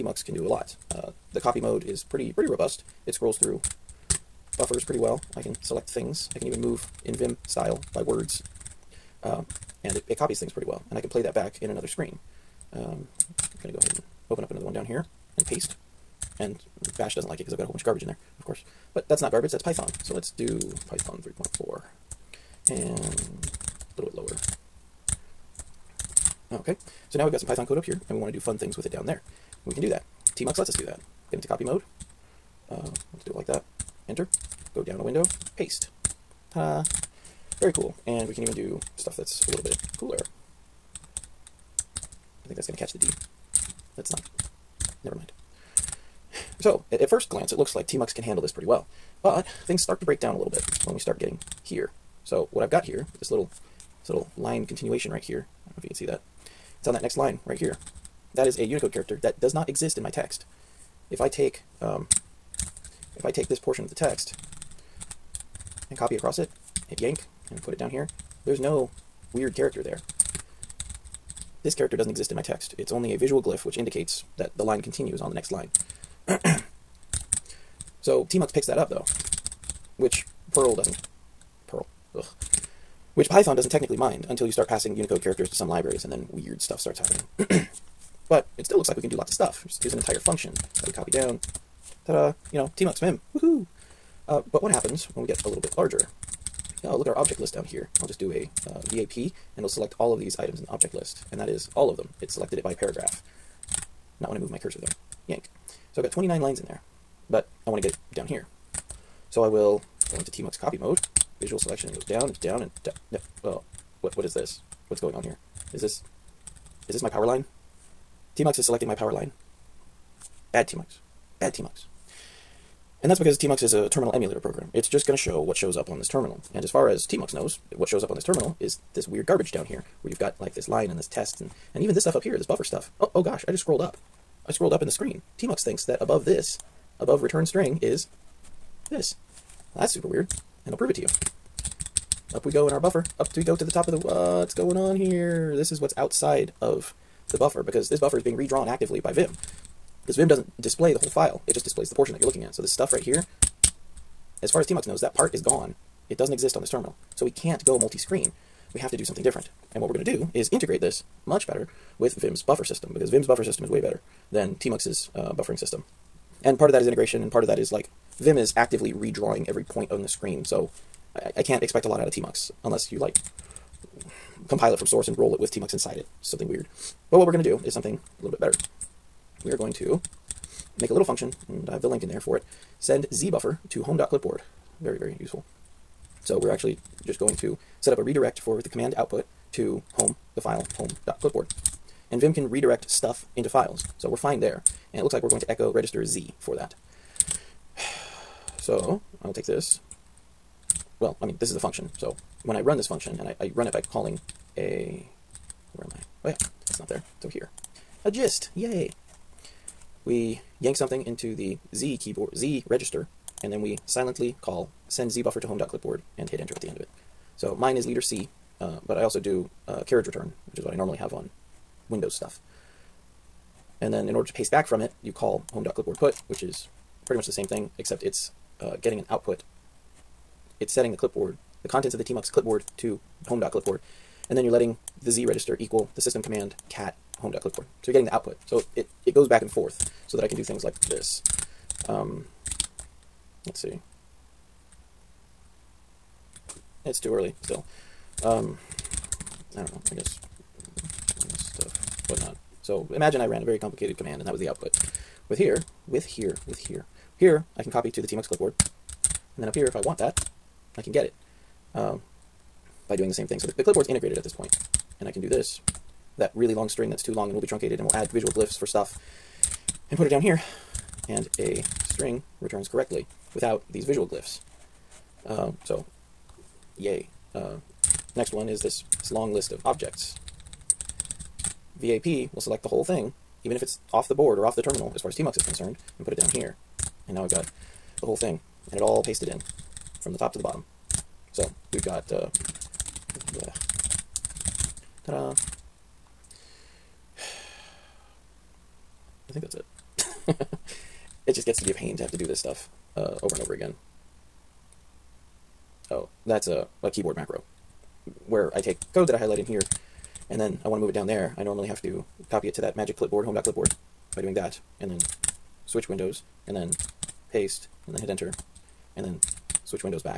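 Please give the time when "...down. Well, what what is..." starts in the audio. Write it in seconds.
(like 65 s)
112 s.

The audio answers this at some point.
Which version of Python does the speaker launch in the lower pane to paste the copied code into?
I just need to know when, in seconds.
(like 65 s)
20 s.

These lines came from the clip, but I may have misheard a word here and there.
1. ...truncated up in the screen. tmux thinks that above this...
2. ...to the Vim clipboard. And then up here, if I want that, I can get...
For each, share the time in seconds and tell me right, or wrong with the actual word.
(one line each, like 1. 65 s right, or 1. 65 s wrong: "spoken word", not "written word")
1. 134 s wrong: "scrolled", not "truncated"
2. 257 s wrong: "TMUX", not "Vim".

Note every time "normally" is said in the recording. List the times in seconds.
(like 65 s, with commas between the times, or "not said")
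220 s, 311 s.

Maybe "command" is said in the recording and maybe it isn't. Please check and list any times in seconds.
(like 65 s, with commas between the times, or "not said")
188 s, 236 s, 253 s.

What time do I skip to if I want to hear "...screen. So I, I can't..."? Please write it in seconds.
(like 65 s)
170 s.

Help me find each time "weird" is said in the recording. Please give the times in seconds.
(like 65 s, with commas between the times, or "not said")
69 s, 86 s, 129 s, 140 s, 176 s.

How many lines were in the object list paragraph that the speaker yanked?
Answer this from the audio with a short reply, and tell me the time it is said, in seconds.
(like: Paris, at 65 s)
29, at 106 s.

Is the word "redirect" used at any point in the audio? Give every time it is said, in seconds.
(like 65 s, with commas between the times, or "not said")
188 s, 192 s.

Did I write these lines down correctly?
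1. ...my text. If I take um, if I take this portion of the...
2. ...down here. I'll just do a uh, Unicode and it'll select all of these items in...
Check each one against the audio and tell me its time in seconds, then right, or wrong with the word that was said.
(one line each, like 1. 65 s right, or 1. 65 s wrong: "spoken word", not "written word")
1. 60 s right
2. 97 s wrong: "VAP", not "Unicode".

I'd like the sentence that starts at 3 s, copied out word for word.
It scrolls through buffers pretty well I can select things.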